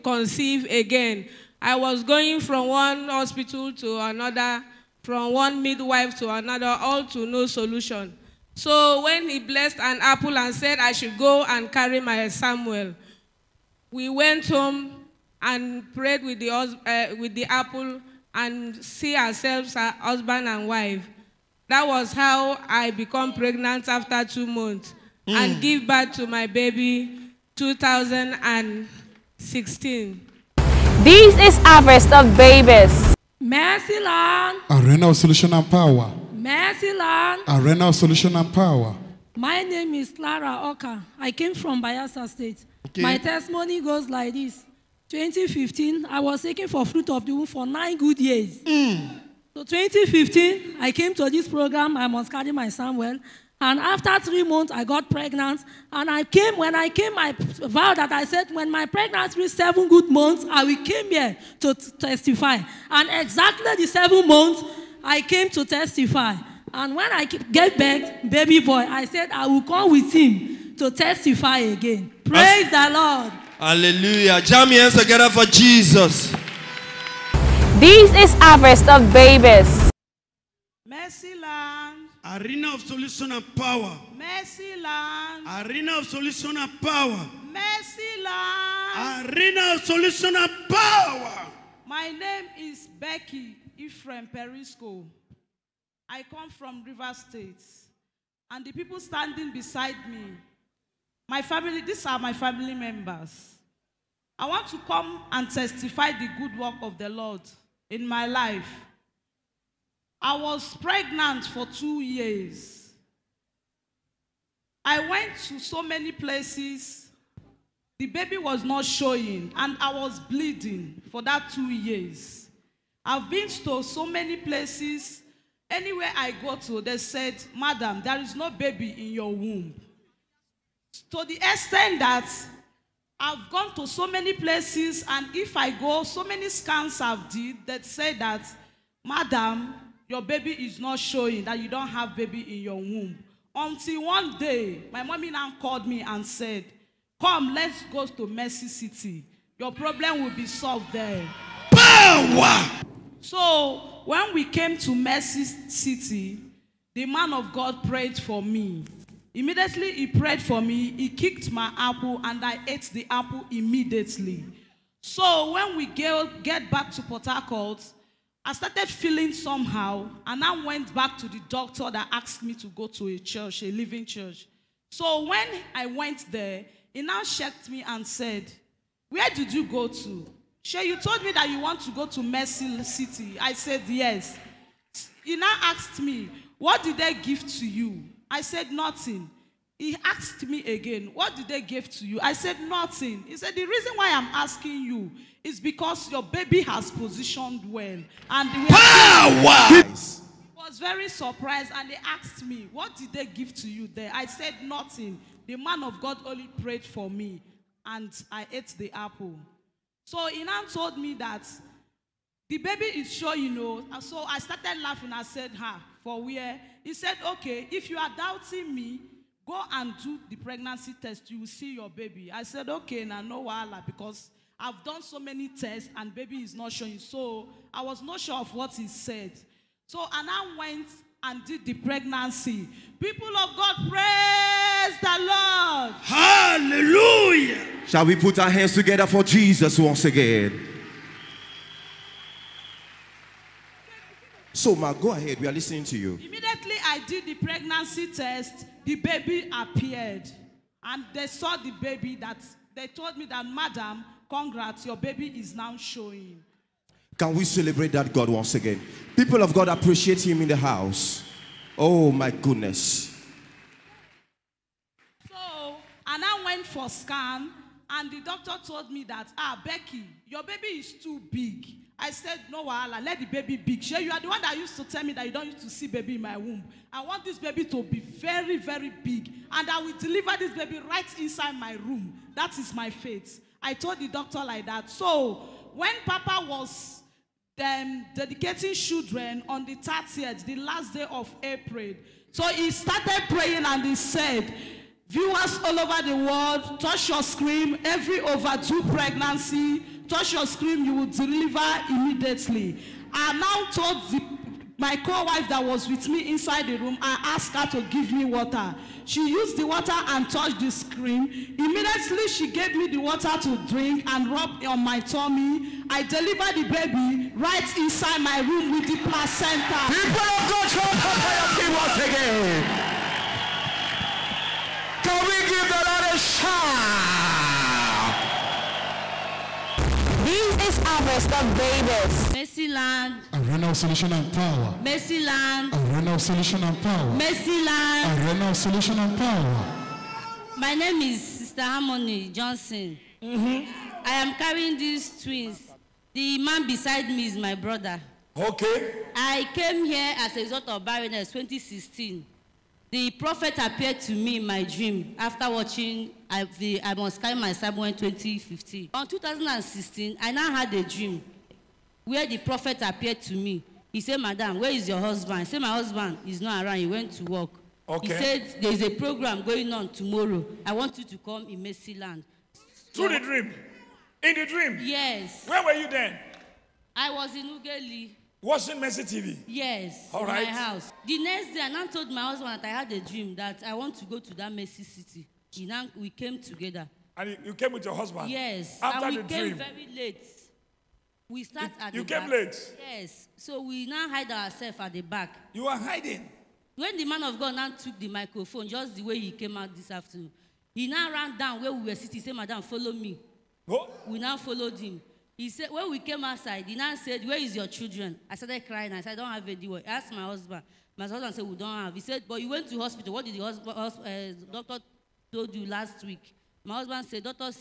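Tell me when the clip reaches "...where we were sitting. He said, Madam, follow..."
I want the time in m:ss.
6:41.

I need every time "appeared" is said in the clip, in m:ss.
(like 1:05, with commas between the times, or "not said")
4:09, 5:53, 6:02.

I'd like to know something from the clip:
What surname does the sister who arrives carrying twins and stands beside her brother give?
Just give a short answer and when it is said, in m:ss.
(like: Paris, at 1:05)
Johnson, at 5:42.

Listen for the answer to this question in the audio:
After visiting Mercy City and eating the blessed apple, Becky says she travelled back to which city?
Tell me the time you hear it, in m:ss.
2:47.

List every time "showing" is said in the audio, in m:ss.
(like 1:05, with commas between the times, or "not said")
1:58, 2:20, 3:46, 4:15.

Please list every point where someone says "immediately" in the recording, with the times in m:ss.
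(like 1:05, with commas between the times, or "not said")
2:39, 2:43, 4:06, 5:01, 5:11.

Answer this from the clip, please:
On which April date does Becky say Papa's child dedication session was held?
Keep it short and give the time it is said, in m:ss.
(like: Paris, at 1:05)
30th April, at 4:49.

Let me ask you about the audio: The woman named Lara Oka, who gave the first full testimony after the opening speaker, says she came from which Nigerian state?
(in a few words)
Bayelsa State.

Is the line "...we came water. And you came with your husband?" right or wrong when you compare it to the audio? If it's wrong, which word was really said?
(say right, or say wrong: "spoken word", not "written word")
wrong: "together", not "water".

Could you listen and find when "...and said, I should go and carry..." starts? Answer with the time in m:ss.
0:10.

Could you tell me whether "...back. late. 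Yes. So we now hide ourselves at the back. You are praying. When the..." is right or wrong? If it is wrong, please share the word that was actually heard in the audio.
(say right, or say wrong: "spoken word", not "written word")
wrong: "hiding", not "praying".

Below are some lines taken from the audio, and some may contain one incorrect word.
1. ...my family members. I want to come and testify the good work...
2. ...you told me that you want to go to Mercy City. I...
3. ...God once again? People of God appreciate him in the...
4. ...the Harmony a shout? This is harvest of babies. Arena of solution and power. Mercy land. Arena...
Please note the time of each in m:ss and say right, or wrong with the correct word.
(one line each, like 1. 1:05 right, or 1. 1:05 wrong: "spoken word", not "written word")
1. 1:42 right
2. 3:00 right
3. 4:18 right
4. 5:25 wrong: "Lord", not "Harmony".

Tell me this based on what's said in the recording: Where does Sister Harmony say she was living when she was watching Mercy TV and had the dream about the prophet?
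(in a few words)
Ugeli.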